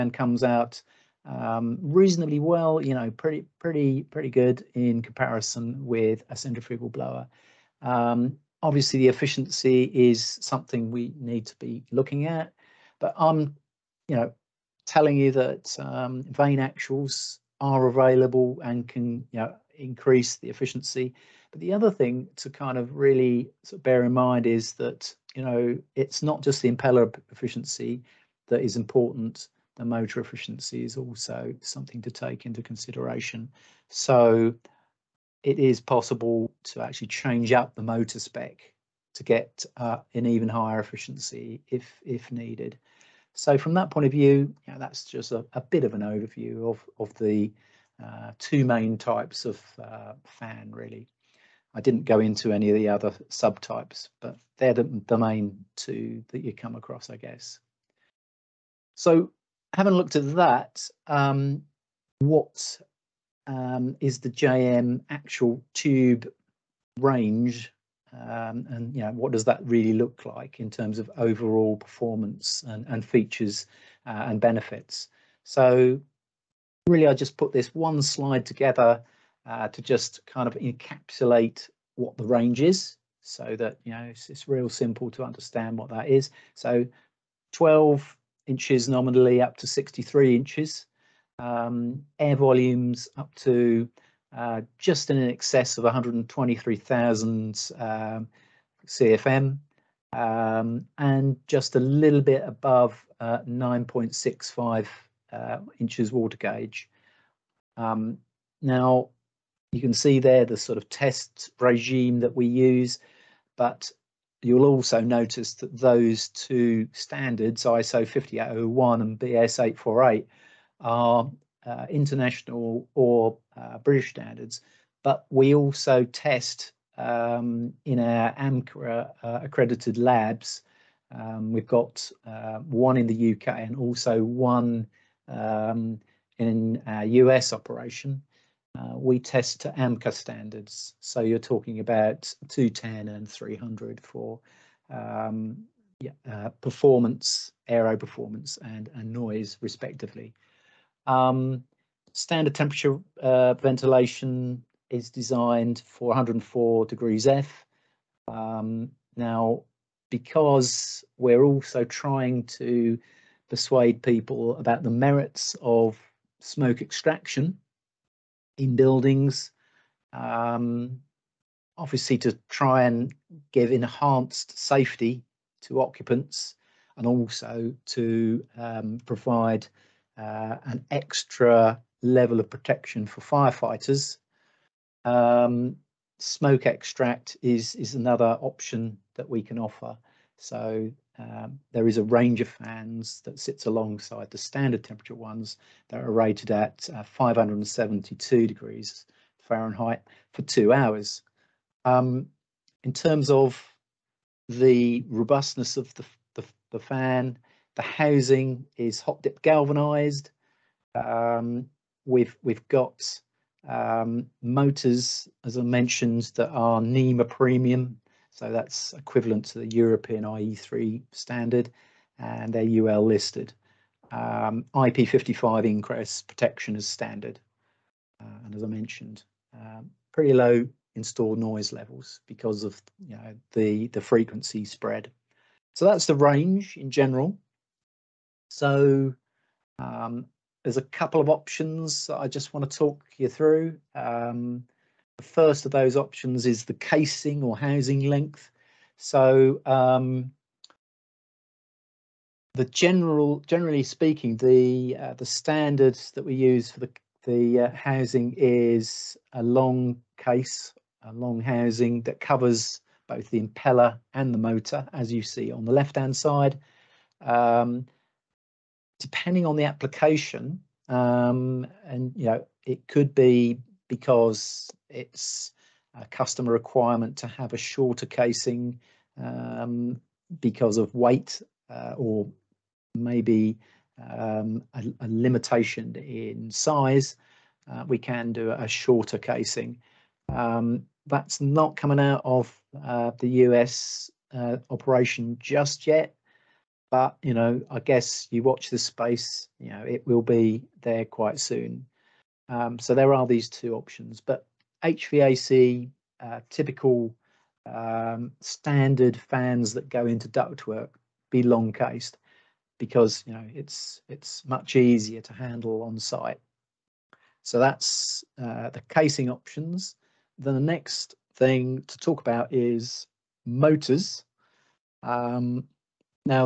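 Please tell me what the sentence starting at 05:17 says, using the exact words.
So that's uh, the casing options.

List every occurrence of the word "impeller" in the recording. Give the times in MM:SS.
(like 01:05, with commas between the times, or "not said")
00:26, 04:23.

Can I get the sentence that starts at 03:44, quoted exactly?
Um, IP55 ingress protection is standard.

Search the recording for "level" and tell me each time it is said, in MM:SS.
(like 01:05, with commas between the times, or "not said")
03:02, 03:51.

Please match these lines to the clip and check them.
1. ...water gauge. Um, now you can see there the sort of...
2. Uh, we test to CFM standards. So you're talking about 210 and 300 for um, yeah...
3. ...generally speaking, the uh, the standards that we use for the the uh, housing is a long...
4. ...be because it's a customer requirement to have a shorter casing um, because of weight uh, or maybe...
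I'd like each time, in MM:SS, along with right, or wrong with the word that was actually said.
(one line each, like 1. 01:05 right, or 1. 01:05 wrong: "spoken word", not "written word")
1. 01:46 right
2. 02:18 wrong: "AMCA", not "CFM"
3. 04:13 right
4. 04:33 right.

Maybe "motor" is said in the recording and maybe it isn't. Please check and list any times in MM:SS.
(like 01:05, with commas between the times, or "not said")
00:29, 00:37, 03:34, 04:24, 05:23.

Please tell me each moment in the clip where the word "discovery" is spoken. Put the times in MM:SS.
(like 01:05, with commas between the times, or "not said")
not said.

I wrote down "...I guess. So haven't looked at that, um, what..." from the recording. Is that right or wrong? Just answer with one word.
right.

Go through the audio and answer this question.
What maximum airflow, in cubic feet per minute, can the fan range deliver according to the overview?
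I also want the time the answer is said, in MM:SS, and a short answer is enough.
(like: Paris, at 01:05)
123,000 CFM, at 01:35.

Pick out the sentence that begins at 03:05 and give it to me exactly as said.
Um, smoke extract is, is another option that we can offer.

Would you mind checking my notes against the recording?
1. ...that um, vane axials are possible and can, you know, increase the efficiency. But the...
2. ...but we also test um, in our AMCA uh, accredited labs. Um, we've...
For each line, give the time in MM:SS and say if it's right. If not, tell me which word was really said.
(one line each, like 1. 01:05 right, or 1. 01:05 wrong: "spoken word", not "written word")
1. 00:15 wrong: "available", not "possible"
2. 02:05 right.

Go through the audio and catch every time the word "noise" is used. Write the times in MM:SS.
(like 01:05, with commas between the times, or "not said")
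02:29, 03:51.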